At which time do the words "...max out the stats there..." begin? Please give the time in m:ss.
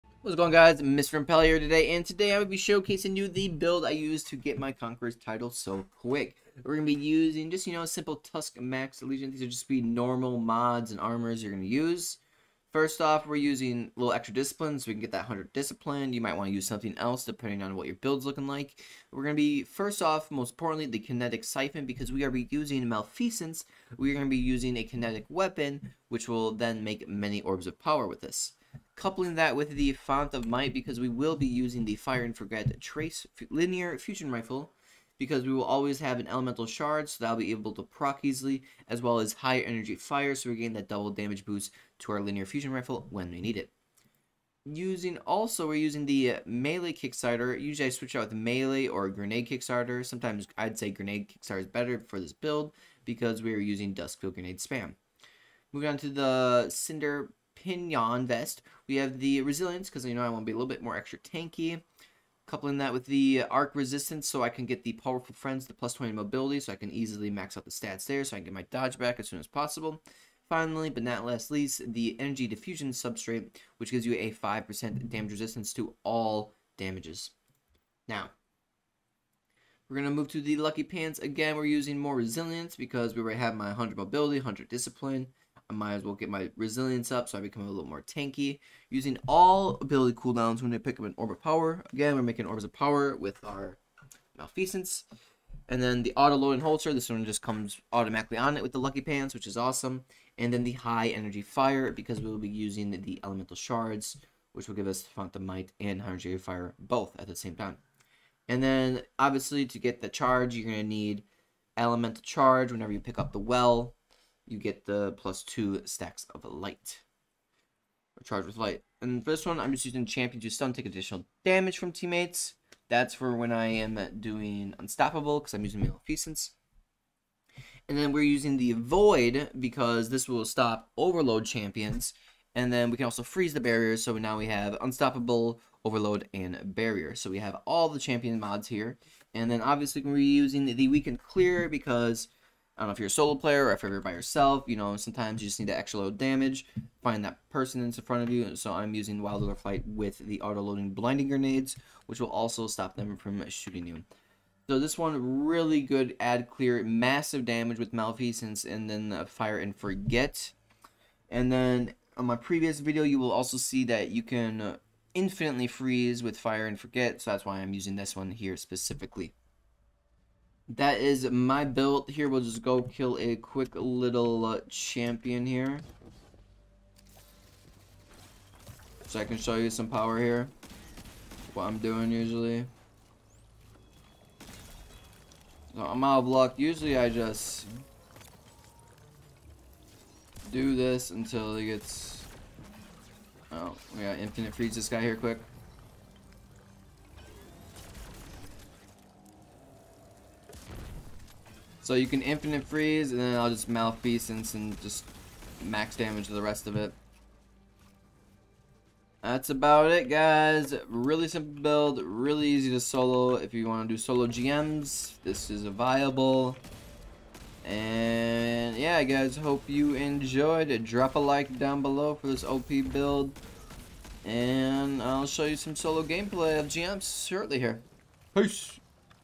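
1:07.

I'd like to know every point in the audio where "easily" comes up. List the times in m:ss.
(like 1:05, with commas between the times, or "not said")
0:38, 1:06.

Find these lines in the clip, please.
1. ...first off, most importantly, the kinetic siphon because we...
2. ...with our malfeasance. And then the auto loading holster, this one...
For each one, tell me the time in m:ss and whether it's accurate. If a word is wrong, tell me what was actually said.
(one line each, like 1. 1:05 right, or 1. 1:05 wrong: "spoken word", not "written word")
1. 0:19 right
2. 1:33 right.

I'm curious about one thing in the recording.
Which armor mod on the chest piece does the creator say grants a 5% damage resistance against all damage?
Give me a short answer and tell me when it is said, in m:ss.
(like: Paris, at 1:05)
Energy Diffusion Substrate, at 1:12.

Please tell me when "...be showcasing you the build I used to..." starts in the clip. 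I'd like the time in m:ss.
0:02.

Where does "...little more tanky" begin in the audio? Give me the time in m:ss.
1:27.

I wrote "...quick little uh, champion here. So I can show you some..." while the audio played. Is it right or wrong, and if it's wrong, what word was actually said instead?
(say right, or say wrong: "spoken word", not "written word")
right.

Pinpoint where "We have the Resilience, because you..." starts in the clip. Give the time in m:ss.
0:58.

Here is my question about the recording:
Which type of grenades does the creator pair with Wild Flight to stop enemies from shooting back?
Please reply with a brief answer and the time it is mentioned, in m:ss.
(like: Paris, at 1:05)
blinding grenades, at 2:30.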